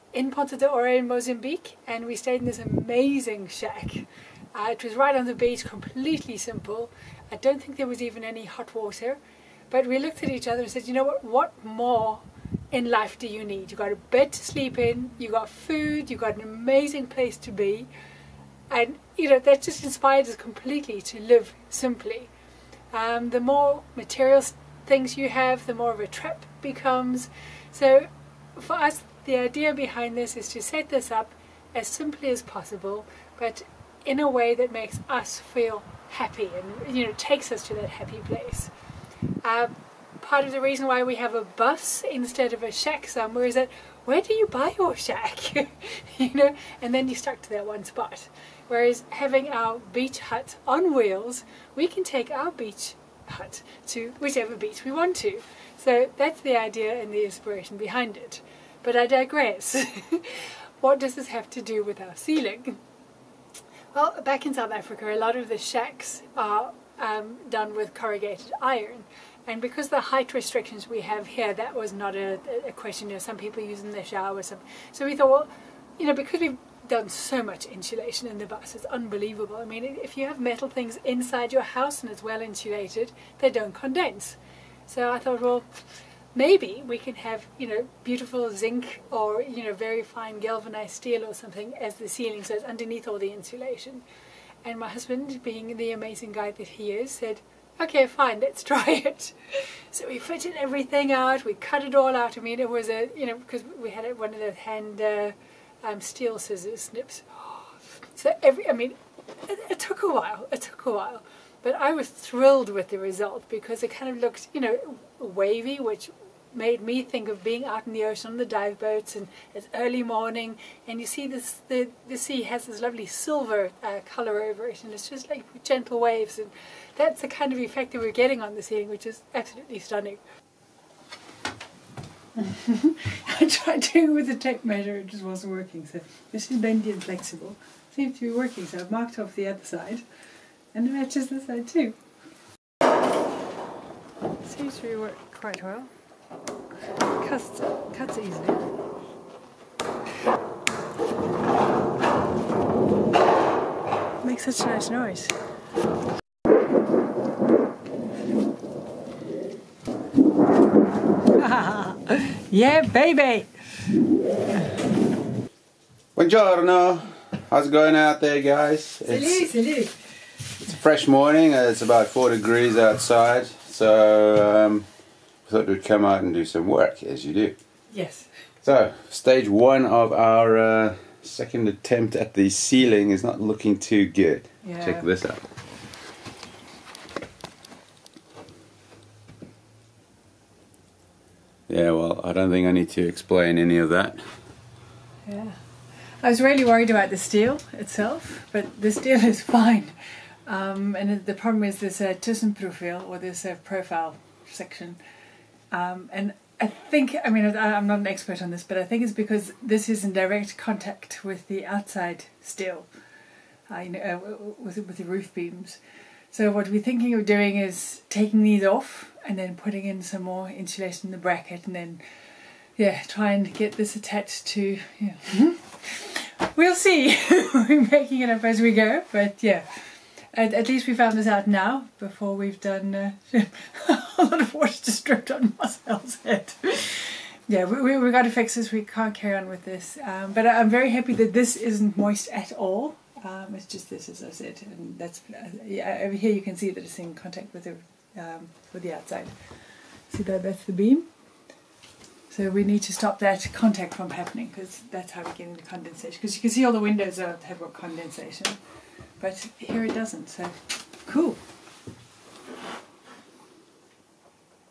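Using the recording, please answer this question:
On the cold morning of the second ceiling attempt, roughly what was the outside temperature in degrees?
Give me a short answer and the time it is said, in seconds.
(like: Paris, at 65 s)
4, at 172 s.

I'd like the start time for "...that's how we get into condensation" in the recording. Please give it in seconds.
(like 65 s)
254 s.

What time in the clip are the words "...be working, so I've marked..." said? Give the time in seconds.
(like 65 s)
138 s.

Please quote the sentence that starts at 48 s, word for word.
Whereas having our beach hut on wheels, we can take our beach hut to whichever beach we want to.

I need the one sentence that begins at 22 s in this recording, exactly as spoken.
Um, the more material things you have, the more of a trap becomes.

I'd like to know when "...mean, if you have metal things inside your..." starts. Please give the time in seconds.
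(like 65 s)
79 s.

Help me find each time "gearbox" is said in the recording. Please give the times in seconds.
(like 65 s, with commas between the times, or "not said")
not said.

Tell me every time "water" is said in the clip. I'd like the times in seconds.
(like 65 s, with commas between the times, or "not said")
8 s, 234 s.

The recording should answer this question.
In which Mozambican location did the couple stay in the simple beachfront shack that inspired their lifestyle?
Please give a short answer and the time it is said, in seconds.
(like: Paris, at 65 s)
Ponta do Ouro, at 0 s.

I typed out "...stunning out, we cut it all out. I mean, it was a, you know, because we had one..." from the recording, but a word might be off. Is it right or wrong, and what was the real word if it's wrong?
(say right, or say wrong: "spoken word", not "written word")
wrong: "everything", not "stunning".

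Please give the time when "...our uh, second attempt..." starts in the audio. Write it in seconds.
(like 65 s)
180 s.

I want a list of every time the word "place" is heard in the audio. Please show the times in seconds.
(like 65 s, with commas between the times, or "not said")
17 s, 38 s.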